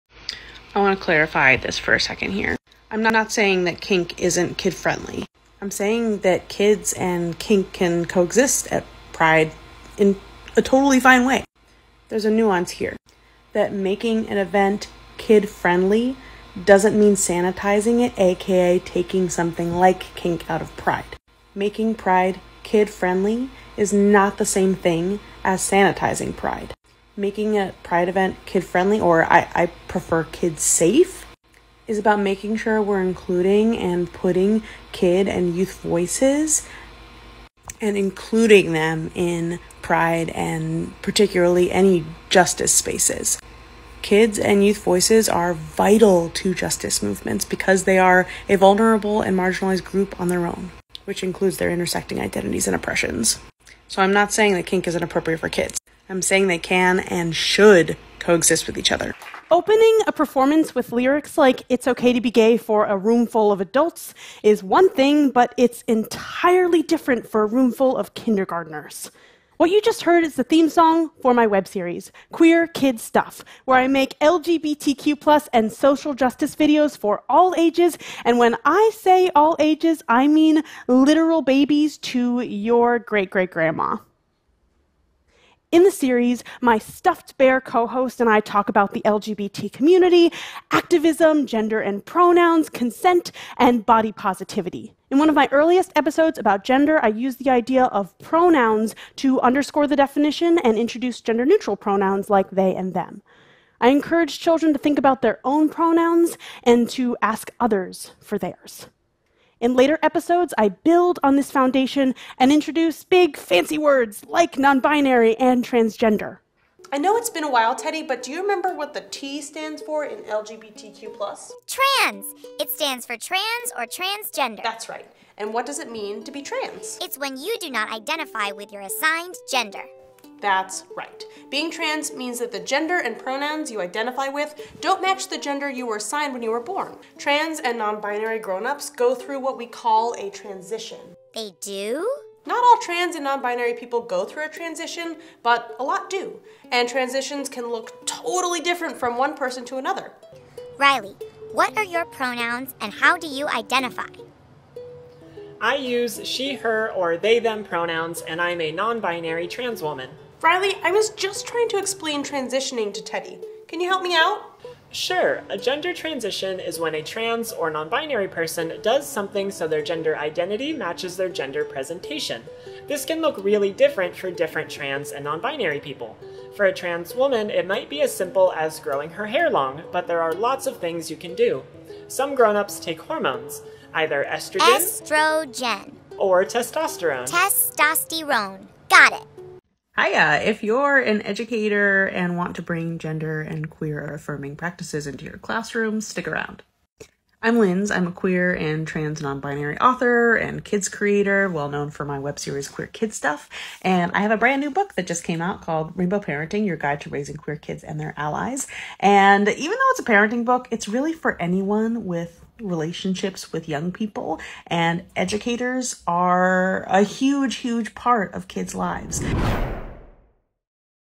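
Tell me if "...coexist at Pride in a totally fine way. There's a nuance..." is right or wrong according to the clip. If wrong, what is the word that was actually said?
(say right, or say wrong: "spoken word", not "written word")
right.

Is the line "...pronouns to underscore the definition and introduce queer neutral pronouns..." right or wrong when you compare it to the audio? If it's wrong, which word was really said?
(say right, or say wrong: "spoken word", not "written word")
wrong: "gender", not "queer".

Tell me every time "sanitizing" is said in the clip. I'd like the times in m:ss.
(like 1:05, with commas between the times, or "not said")
0:17, 0:25.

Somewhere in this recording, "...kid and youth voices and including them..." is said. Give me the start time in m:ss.
0:34.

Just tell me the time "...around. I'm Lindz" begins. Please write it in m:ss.
3:16.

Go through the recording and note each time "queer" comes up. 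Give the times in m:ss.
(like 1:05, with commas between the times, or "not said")
1:12, 3:13, 3:18, 3:22, 3:27.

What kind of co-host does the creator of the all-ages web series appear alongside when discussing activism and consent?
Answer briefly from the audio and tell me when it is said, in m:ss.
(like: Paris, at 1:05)
stuffed bear, at 1:26.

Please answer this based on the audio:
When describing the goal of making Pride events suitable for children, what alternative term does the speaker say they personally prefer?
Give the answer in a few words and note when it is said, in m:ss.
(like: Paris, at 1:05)
kids safe, at 0:30.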